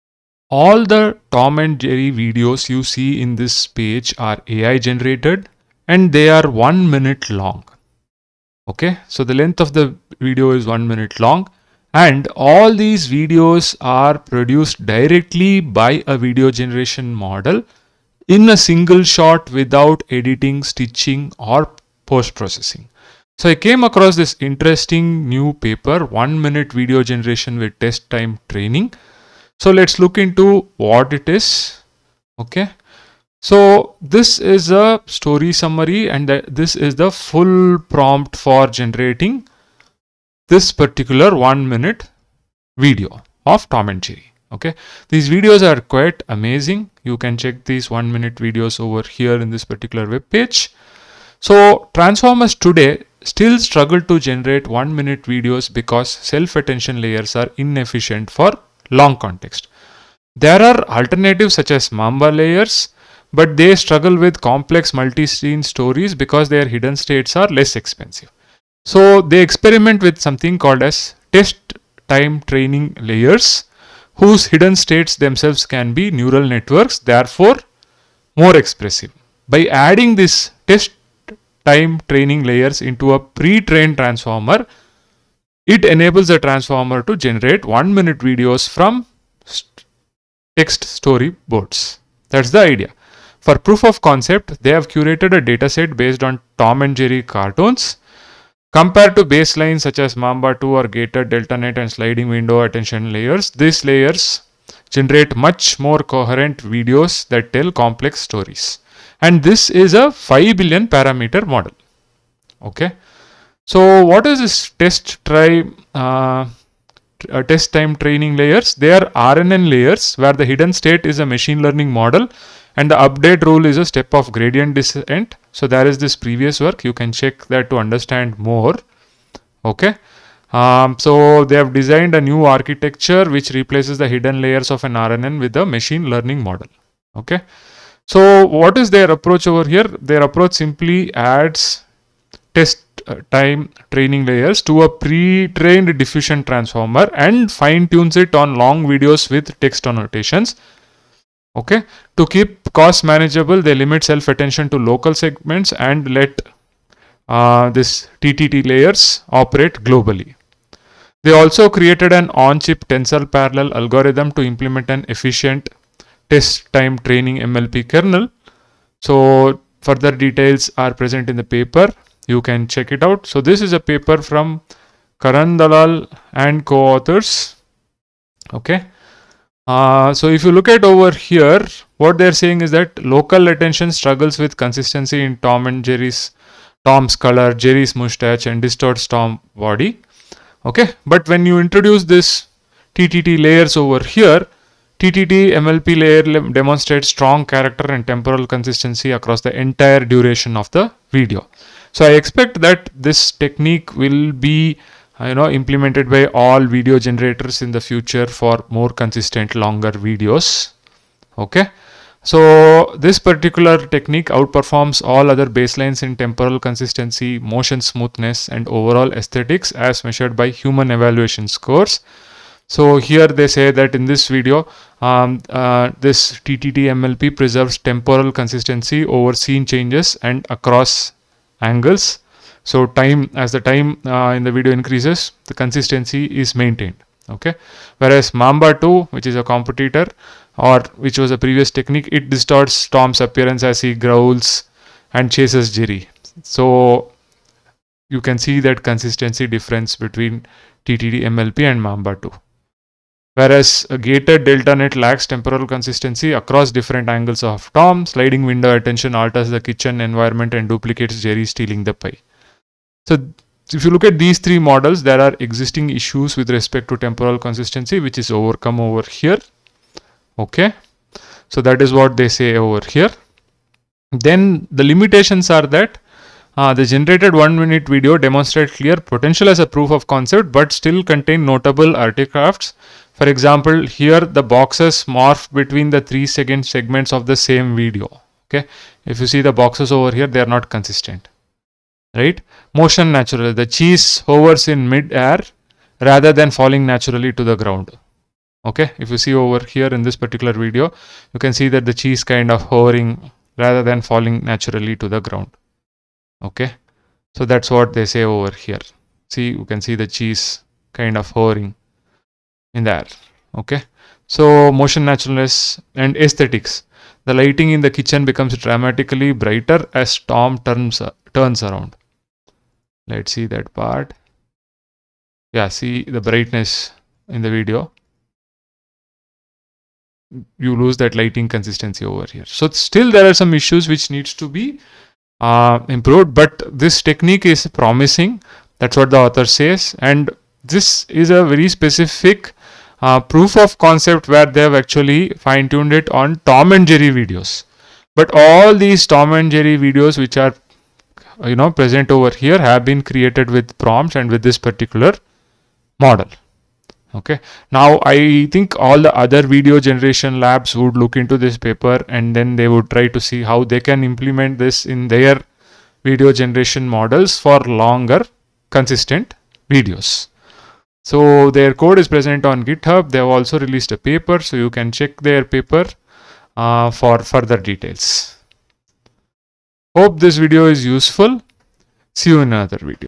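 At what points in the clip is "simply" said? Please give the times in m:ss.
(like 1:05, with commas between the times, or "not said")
2:20.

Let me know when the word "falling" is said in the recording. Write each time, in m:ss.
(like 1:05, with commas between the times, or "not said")
4:56, 5:04.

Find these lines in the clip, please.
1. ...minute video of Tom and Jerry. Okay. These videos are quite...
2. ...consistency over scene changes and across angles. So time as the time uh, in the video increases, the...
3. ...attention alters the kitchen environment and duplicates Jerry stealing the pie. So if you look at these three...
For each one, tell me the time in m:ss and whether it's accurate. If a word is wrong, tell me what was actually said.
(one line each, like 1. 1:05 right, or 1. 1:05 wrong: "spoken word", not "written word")
1. 0:41 right
2. 3:48 right
3. 4:18 right.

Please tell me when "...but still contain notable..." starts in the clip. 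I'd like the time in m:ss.
4:40.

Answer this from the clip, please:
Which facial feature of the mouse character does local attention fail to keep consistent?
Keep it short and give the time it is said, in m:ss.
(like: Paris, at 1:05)
Mustache, at 3:07.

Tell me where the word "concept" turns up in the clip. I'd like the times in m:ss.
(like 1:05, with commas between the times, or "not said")
1:34, 4:40, 5:43.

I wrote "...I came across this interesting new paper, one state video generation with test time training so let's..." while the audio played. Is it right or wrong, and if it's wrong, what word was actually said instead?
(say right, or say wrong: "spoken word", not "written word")
wrong: "minute", not "state".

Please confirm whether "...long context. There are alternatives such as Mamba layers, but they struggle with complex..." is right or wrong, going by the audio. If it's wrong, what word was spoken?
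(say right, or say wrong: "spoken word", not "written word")
right.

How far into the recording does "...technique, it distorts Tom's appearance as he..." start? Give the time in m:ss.
4:01.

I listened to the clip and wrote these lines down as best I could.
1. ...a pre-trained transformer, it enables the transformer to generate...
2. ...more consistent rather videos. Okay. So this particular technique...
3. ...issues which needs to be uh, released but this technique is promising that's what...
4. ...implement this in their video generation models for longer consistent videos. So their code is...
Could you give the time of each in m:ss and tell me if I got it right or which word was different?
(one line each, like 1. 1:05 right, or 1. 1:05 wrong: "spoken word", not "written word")
1. 1:23 right
2. 3:28 wrong: "longer", not "rather"
3. 5:33 wrong: "improved", not "released"
4. 6:04 right.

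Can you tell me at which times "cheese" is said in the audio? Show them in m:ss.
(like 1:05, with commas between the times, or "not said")
4:53, 5:01, 5:10.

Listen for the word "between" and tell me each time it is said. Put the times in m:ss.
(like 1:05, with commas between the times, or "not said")
4:09, 4:45.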